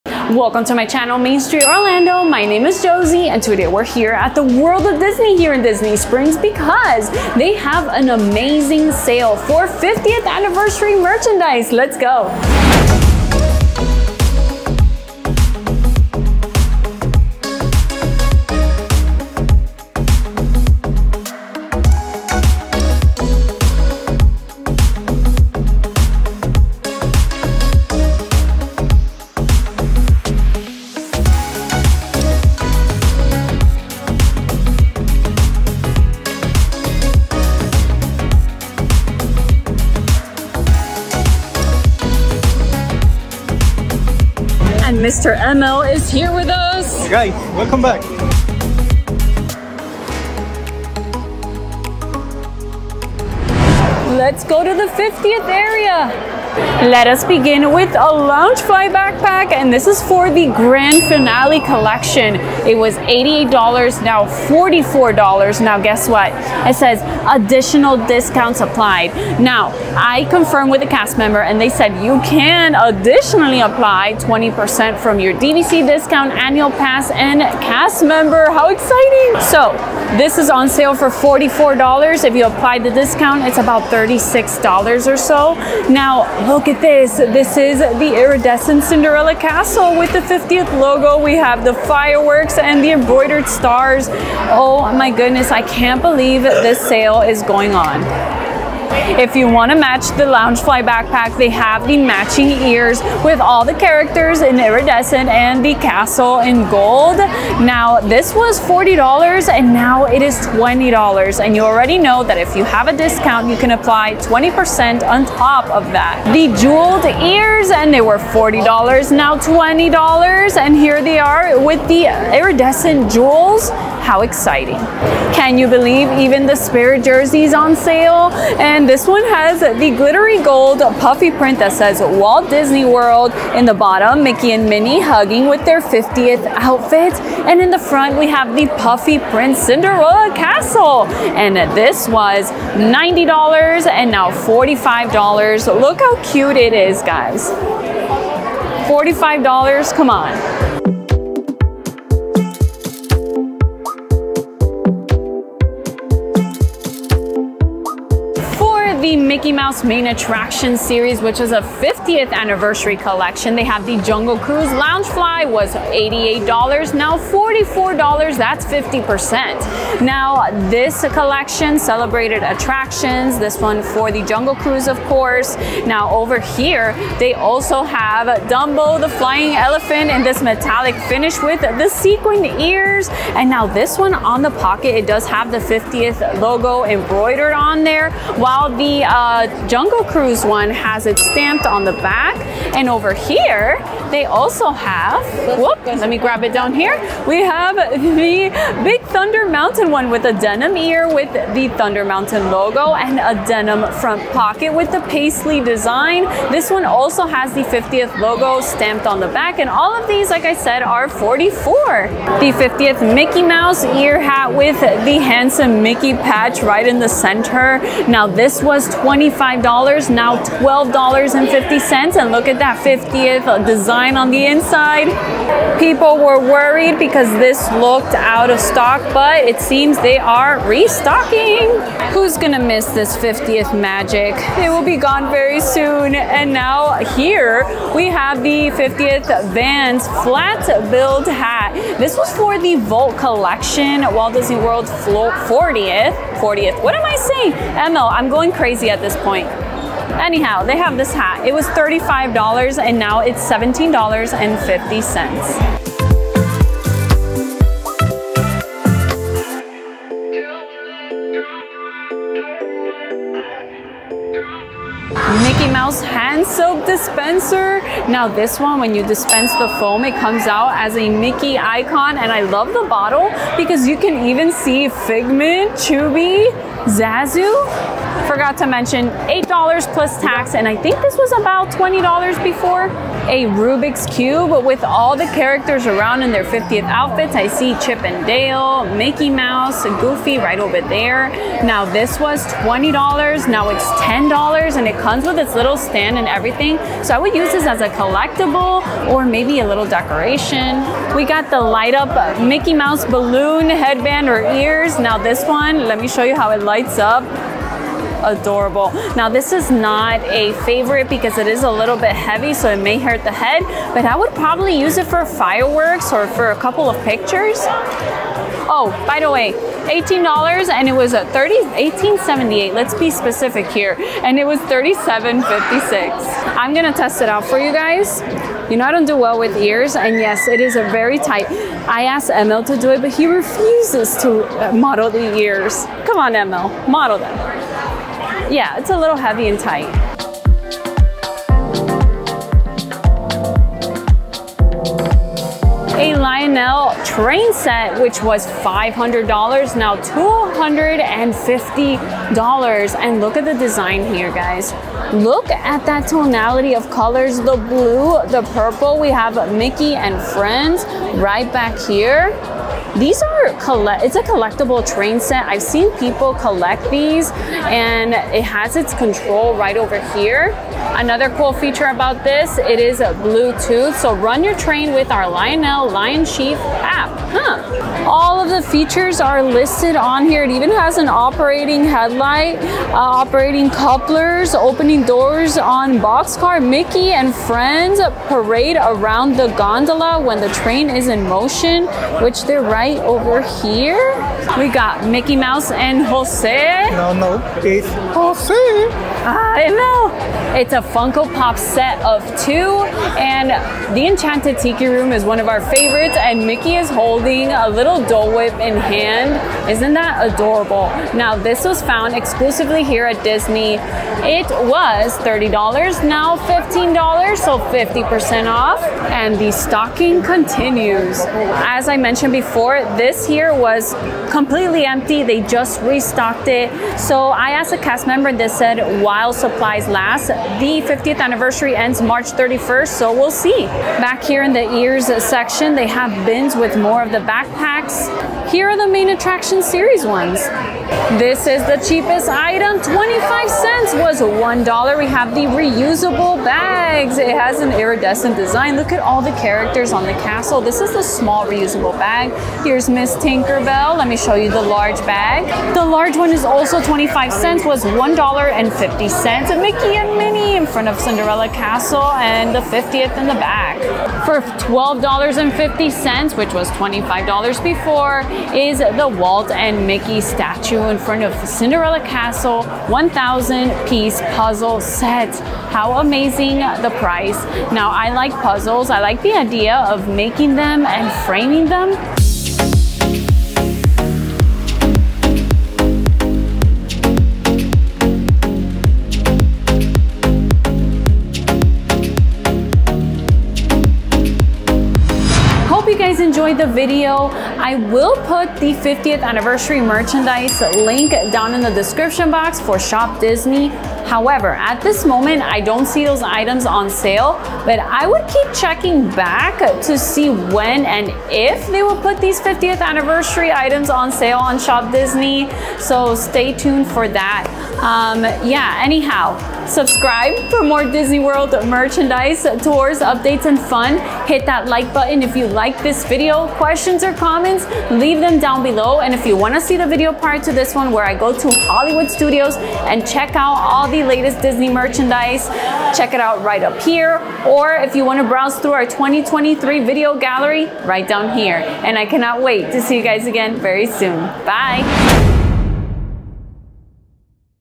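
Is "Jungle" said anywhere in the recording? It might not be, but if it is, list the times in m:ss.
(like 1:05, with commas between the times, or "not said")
2:44, 2:54, 3:09.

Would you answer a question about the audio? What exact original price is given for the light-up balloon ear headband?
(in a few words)
$37.56.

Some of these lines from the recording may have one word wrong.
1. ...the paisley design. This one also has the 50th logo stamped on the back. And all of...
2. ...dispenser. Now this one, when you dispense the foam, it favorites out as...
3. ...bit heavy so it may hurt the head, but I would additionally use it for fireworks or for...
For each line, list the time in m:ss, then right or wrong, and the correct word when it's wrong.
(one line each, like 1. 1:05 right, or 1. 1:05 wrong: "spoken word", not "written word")
1. 3:24 right
2. 4:26 wrong: "comes", not "favorites"
3. 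5:11 wrong: "probably", not "additionally".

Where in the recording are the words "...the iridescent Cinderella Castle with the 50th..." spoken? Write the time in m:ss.
1:27.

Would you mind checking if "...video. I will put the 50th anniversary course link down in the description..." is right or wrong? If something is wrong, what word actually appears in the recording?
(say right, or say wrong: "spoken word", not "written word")
wrong: "merchandise", not "course".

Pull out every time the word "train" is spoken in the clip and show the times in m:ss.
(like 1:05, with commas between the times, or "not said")
5:47, 6:04, 6:14, 6:30.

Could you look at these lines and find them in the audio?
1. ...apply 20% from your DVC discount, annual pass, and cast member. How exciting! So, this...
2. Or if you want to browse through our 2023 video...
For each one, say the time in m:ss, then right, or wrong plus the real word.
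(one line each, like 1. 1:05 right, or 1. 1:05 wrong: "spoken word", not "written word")
1. 1:13 right
2. 8:57 right.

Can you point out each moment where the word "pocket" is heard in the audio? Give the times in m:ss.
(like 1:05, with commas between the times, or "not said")
3:04, 3:24.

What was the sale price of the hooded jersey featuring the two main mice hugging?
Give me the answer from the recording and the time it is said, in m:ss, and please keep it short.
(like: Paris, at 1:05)
$45, at 2:24.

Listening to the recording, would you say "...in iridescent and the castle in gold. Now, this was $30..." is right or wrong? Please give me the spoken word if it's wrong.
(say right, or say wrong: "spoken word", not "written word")
wrong: "40", not "30".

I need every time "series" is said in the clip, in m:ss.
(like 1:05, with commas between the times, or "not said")
2:40, 7:19.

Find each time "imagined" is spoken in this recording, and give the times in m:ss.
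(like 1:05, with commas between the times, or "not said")
not said.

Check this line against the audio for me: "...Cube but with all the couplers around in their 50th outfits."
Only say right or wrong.
wrong.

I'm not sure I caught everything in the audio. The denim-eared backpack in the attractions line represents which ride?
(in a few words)
Big Thunder Mountain.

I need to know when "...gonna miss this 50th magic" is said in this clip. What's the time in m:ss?
3:52.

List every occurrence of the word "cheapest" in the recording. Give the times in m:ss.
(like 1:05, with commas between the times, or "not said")
7:21.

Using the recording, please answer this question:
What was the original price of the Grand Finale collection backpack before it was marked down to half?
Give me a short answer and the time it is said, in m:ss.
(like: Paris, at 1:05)
$88, at 1:02.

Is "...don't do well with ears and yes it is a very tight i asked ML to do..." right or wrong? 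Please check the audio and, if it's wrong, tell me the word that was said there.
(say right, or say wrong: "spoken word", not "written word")
right.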